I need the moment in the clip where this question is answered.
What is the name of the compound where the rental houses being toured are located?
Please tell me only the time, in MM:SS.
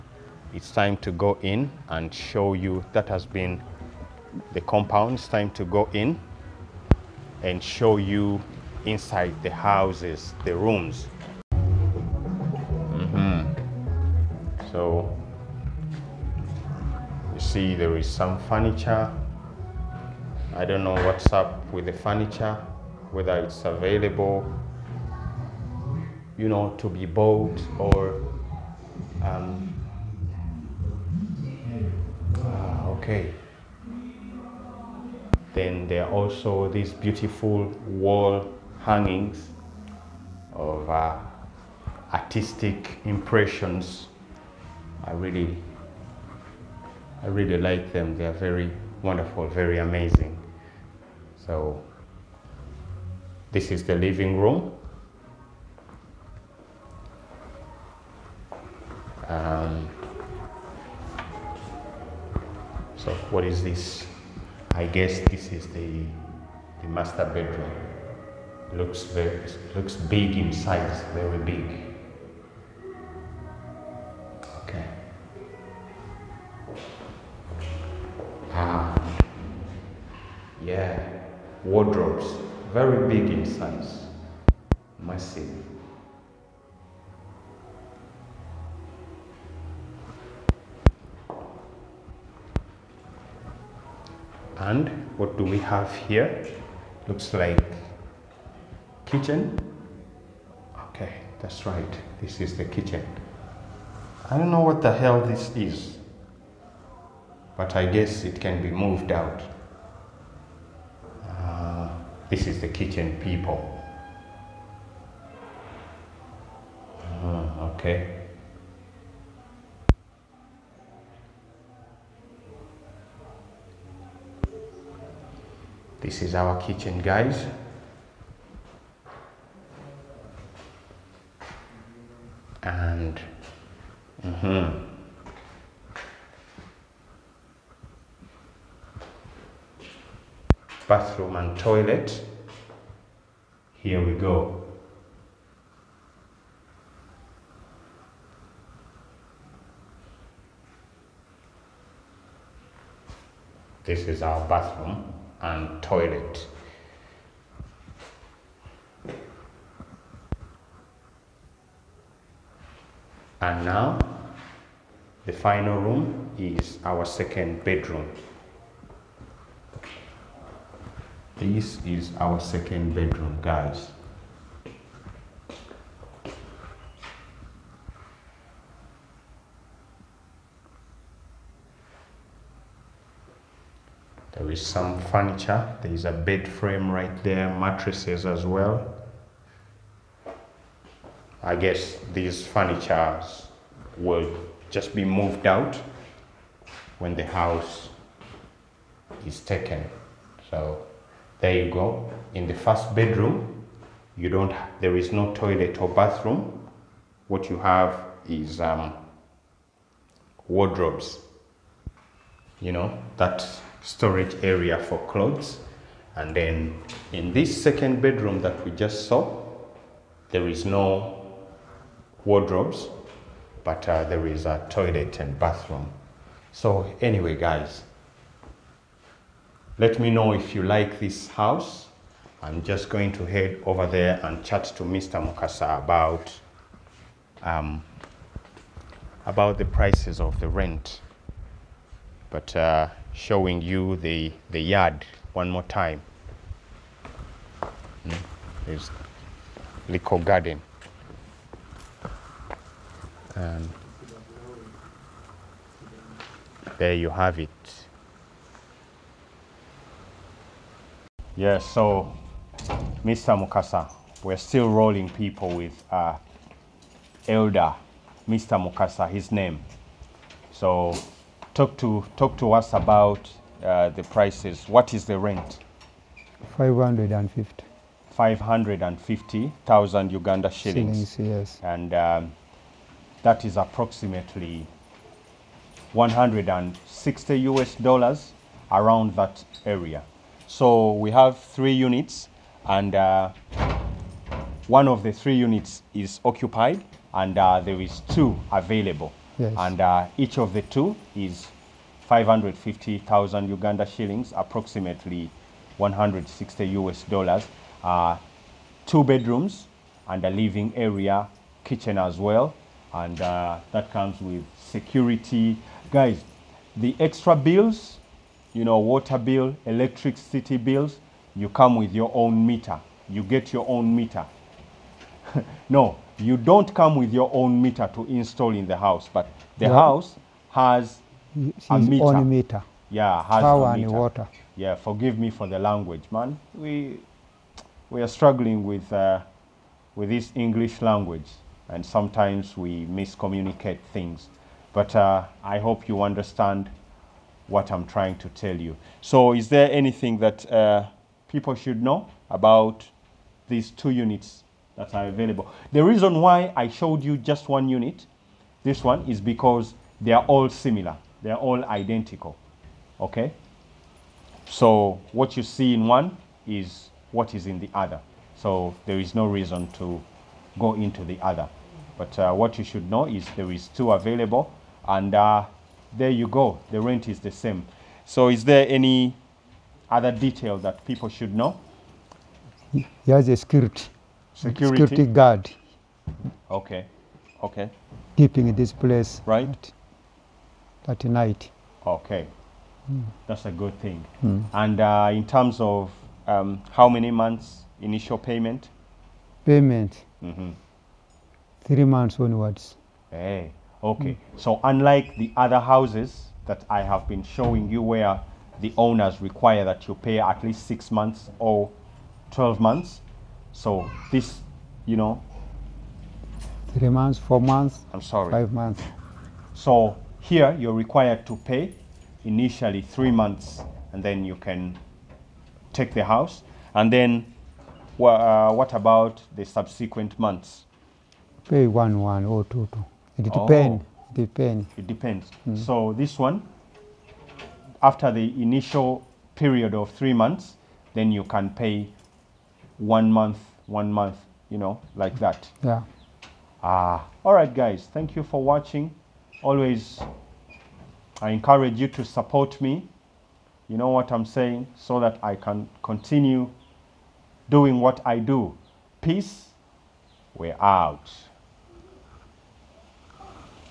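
04:09.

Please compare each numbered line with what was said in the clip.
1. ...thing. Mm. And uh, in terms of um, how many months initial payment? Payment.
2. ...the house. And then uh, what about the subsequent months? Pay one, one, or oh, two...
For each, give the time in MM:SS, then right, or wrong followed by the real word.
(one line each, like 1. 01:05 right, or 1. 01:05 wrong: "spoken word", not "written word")
1. 06:33 right
2. 07:05 right.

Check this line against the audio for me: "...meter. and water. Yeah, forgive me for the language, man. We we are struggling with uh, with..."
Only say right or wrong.
right.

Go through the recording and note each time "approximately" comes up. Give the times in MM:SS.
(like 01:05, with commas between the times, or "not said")
04:43, 05:04.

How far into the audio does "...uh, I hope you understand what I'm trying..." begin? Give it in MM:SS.
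05:44.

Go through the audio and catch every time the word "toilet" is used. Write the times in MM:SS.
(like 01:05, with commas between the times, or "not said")
02:21, 02:35, 03:25, 03:44.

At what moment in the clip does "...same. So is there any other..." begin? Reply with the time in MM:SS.
06:17.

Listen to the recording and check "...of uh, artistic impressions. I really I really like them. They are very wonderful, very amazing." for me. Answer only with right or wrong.
right.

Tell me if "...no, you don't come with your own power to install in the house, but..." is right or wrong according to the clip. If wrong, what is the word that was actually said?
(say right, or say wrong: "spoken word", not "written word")
wrong: "meter", not "power".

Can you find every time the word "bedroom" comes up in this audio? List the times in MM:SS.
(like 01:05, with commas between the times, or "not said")
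01:07, 02:47, 02:52, 03:22, 03:38, 05:09.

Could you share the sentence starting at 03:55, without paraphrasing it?
Mukasa about um, about the prices of the rent.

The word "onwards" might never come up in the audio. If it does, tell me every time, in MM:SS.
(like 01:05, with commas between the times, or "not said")
06:42.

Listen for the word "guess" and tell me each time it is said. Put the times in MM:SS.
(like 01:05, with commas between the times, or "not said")
01:04, 01:47, 03:11.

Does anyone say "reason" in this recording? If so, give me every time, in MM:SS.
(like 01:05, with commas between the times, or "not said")
05:55, 06:09.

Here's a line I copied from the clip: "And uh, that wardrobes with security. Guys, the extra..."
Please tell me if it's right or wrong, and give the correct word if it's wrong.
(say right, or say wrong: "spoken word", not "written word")
wrong: "comes", not "wardrobes".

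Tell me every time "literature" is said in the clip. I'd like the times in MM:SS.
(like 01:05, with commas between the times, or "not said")
not said.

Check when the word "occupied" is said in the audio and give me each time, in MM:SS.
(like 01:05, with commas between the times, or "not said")
04:56.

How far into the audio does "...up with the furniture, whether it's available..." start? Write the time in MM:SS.
00:21.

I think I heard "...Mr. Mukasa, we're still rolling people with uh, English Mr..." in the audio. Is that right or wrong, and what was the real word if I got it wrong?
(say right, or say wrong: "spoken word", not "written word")
wrong: "Elder", not "English".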